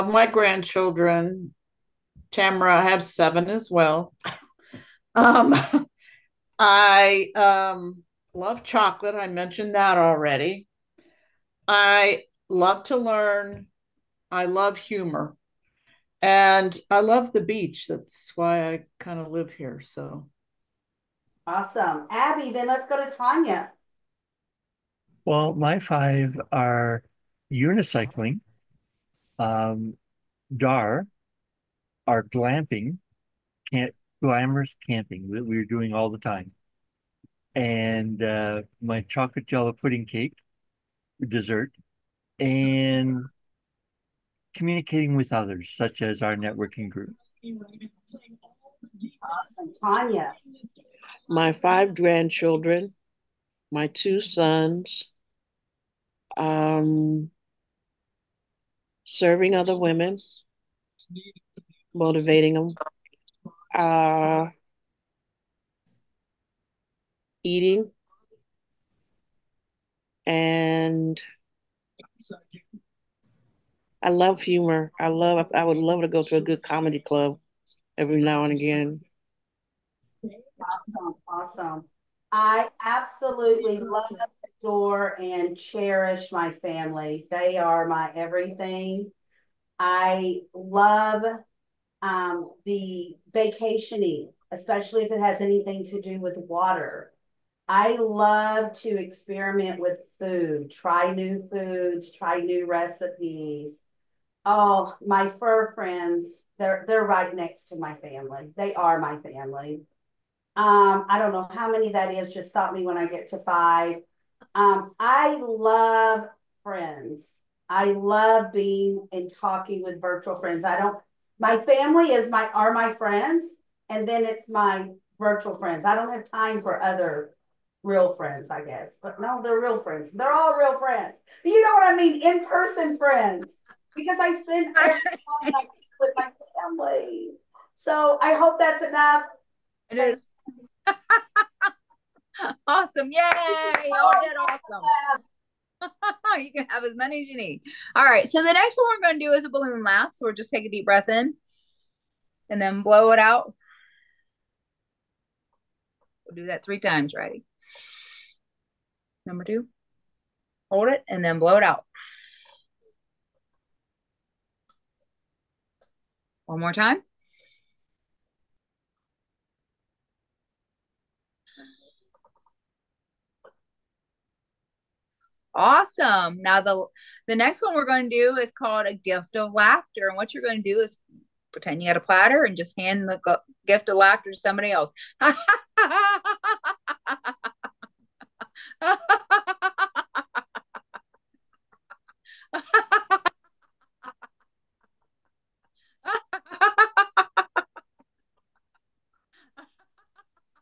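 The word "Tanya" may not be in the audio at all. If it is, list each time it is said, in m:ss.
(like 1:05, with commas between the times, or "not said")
0:23, 0:49.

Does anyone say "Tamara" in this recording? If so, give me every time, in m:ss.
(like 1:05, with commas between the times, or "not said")
0:02.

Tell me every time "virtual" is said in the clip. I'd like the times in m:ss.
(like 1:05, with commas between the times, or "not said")
2:00, 2:05.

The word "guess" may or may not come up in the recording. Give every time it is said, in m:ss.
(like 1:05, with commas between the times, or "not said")
2:08.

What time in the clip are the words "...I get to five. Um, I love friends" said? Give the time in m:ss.
1:52.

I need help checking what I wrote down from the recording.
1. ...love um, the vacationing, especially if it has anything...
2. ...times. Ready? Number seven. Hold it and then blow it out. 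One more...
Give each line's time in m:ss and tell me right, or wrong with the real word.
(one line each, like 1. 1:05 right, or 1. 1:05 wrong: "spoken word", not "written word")
1. 1:30 right
2. 2:36 wrong: "two", not "seven".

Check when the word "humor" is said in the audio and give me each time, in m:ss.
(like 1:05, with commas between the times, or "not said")
0:14, 1:14.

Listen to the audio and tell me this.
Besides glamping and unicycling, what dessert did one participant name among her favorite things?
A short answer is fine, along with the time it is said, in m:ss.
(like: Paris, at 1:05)
Chocolate jello pudding cake, at 0:39.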